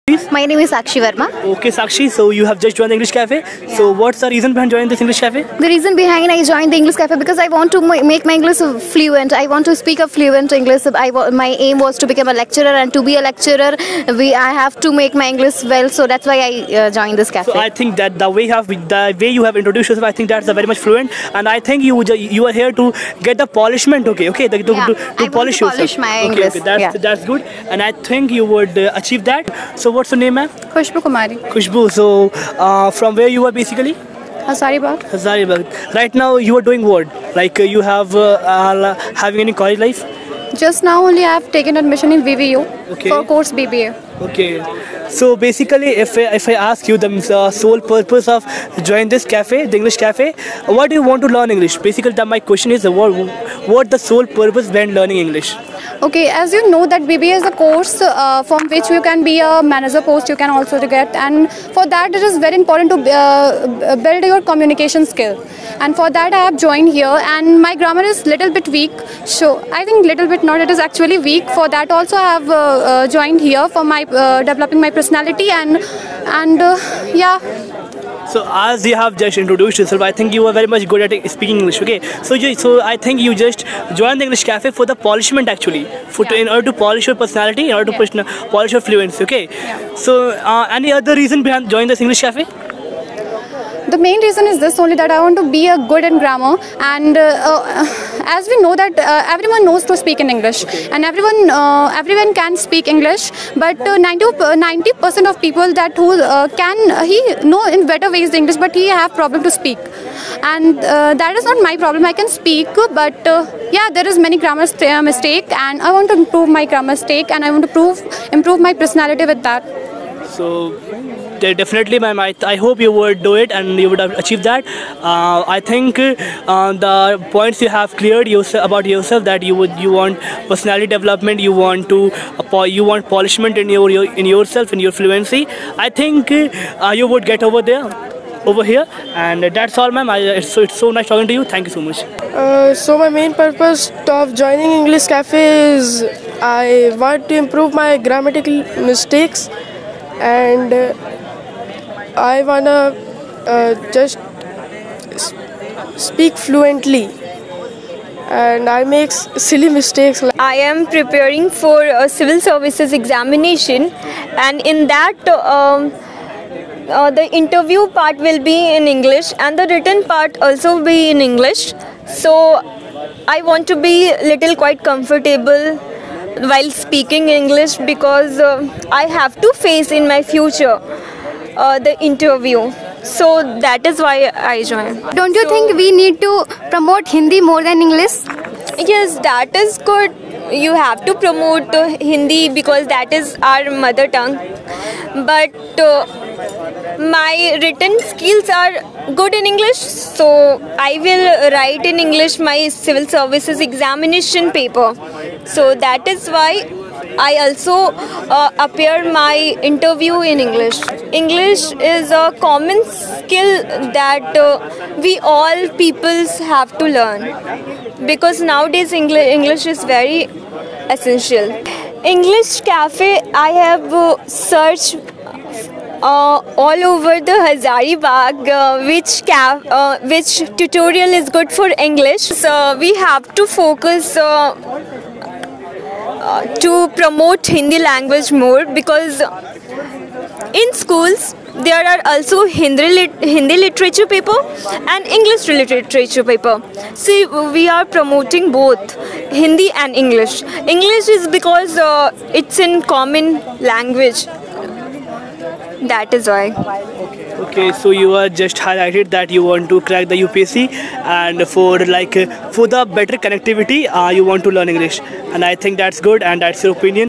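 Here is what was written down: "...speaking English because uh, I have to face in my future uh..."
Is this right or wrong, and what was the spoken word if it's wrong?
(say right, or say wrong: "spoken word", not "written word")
right.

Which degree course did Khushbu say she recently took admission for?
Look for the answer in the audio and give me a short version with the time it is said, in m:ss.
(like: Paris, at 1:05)
BBA, at 0:43.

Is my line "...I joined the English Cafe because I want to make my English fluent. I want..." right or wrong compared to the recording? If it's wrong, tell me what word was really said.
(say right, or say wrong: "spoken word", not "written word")
right.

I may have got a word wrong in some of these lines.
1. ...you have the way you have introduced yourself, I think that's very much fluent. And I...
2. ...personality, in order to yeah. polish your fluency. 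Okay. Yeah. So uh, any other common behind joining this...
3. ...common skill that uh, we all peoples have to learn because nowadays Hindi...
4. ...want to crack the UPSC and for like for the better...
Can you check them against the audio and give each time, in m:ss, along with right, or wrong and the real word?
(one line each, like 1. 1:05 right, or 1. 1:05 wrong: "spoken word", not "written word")
1. 0:18 right
2. 1:27 wrong: "reason", not "common"
3. 3:32 wrong: "English", not "Hindi"
4. 4:19 right.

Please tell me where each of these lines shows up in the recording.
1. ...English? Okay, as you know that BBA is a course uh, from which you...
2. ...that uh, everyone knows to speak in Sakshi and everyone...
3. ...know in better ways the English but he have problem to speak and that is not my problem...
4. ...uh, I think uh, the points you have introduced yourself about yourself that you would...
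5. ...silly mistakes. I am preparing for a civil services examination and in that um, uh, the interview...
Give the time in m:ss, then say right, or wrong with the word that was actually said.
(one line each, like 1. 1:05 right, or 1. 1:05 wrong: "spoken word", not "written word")
1. 0:55 right
2. 1:38 wrong: "English", not "Sakshi"
3. 1:47 right
4. 2:05 wrong: "cleared", not "introduced"
5. 2:39 right.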